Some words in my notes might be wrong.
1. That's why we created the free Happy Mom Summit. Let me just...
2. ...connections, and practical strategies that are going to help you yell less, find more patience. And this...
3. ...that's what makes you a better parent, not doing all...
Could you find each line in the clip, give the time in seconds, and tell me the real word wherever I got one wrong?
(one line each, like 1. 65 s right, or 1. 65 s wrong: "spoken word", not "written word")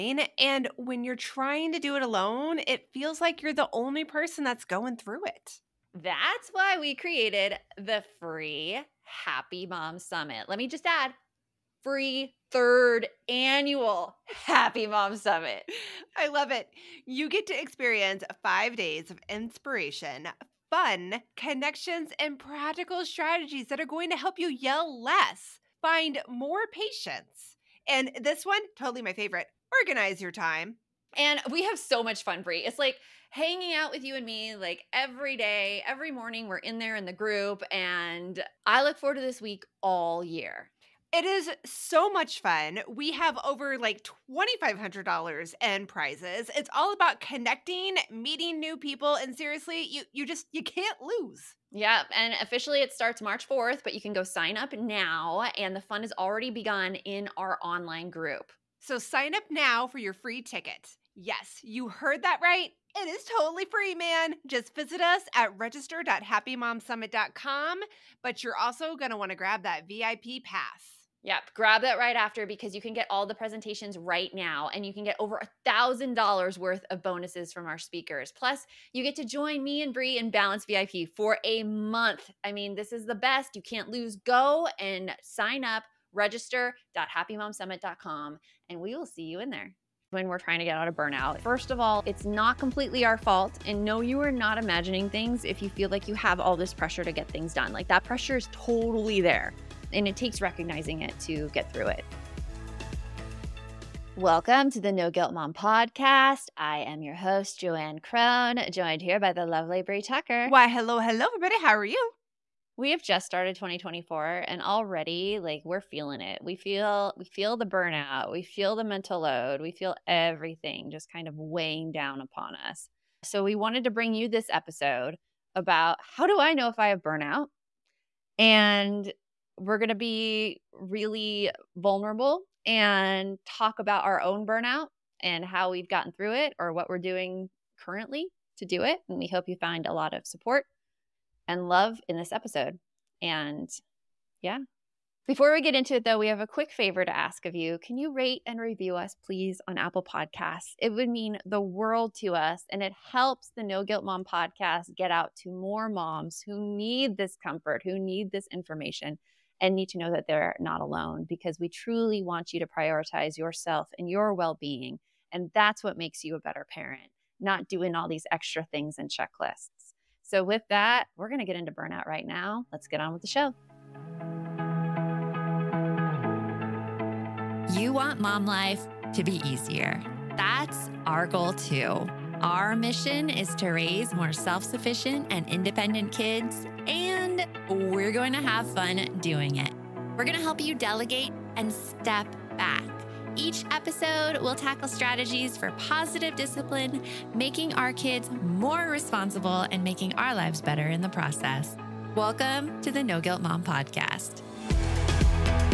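1. 5 s right
2. 21 s right
3. 165 s right.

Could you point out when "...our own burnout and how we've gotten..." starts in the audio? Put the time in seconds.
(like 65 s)
134 s.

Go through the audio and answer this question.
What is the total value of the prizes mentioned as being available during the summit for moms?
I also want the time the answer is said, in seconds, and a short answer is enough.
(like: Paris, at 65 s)
$2500, at 44 s.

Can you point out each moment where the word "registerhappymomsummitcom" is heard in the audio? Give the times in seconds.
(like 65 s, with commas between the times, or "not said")
65 s, 86 s.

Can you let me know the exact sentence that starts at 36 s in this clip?
We're in there in the group.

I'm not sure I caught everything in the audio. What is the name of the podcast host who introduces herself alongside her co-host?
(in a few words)
Joanne Crohn.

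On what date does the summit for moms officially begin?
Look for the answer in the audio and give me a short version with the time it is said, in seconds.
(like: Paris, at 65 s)
March 4th, at 53 s.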